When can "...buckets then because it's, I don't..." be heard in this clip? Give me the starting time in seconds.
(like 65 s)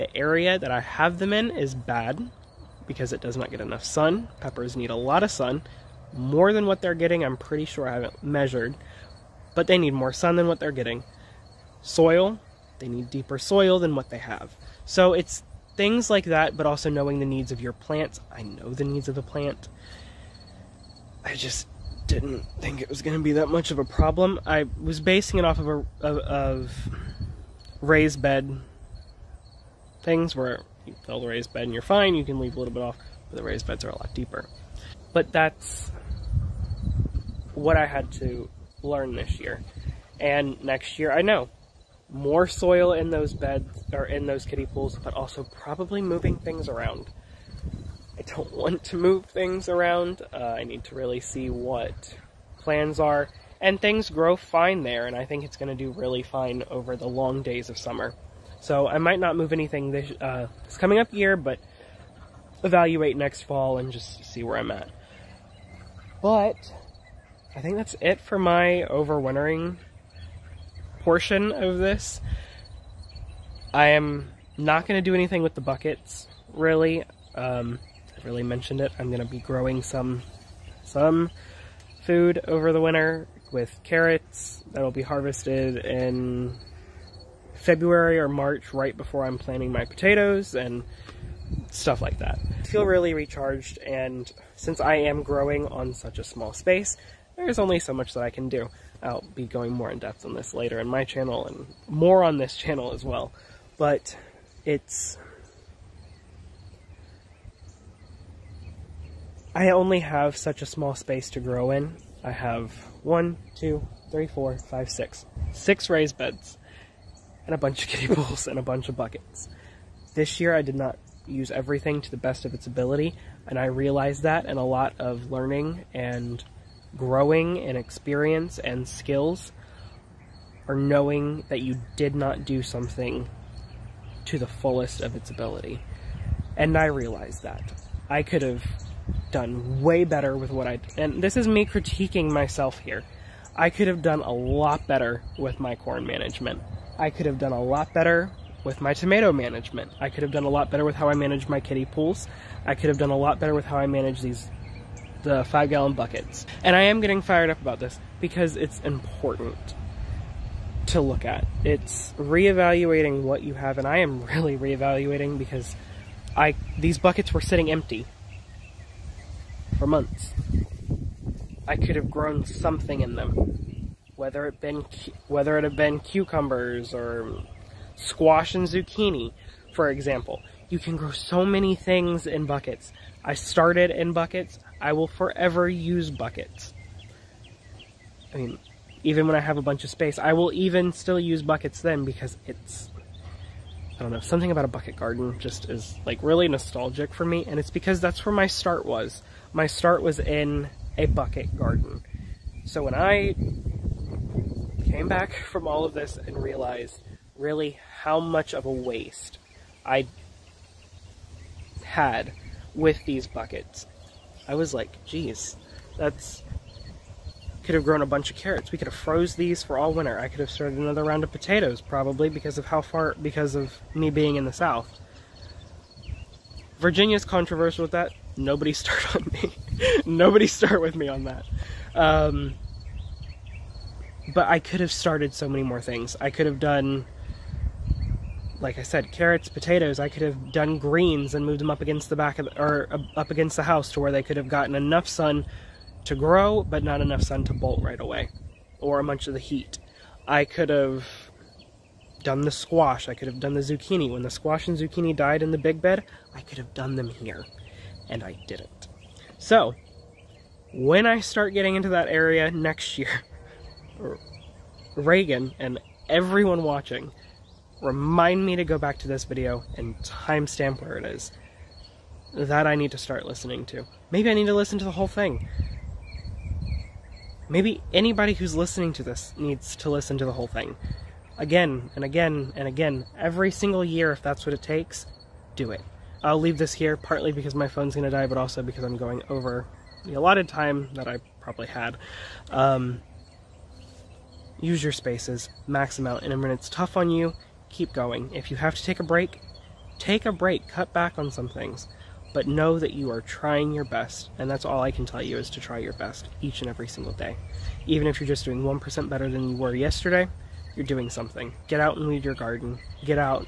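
191 s.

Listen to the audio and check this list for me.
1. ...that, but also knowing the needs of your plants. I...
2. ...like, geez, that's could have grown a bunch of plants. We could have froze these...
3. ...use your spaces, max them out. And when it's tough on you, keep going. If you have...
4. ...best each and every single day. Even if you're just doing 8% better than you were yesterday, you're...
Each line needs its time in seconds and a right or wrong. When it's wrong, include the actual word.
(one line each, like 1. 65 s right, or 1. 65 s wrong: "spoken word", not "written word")
1. 16 s right
2. 214 s wrong: "carrots", not "plants"
3. 294 s right
4. 305 s wrong: "1", not "8".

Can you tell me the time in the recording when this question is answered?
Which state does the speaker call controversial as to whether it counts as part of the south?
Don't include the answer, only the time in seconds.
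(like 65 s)
226 s.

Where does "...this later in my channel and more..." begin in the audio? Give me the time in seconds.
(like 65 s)
100 s.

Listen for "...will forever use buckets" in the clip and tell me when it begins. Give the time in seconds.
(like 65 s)
184 s.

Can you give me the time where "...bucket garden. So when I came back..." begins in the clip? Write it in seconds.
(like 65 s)
201 s.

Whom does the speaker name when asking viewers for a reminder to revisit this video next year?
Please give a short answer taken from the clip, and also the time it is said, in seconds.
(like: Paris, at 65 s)
Reagan, at 264 s.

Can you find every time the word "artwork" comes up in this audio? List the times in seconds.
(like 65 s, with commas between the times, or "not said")
not said.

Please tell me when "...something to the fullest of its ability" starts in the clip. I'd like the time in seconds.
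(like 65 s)
132 s.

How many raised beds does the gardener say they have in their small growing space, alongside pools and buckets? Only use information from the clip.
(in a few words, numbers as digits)
6.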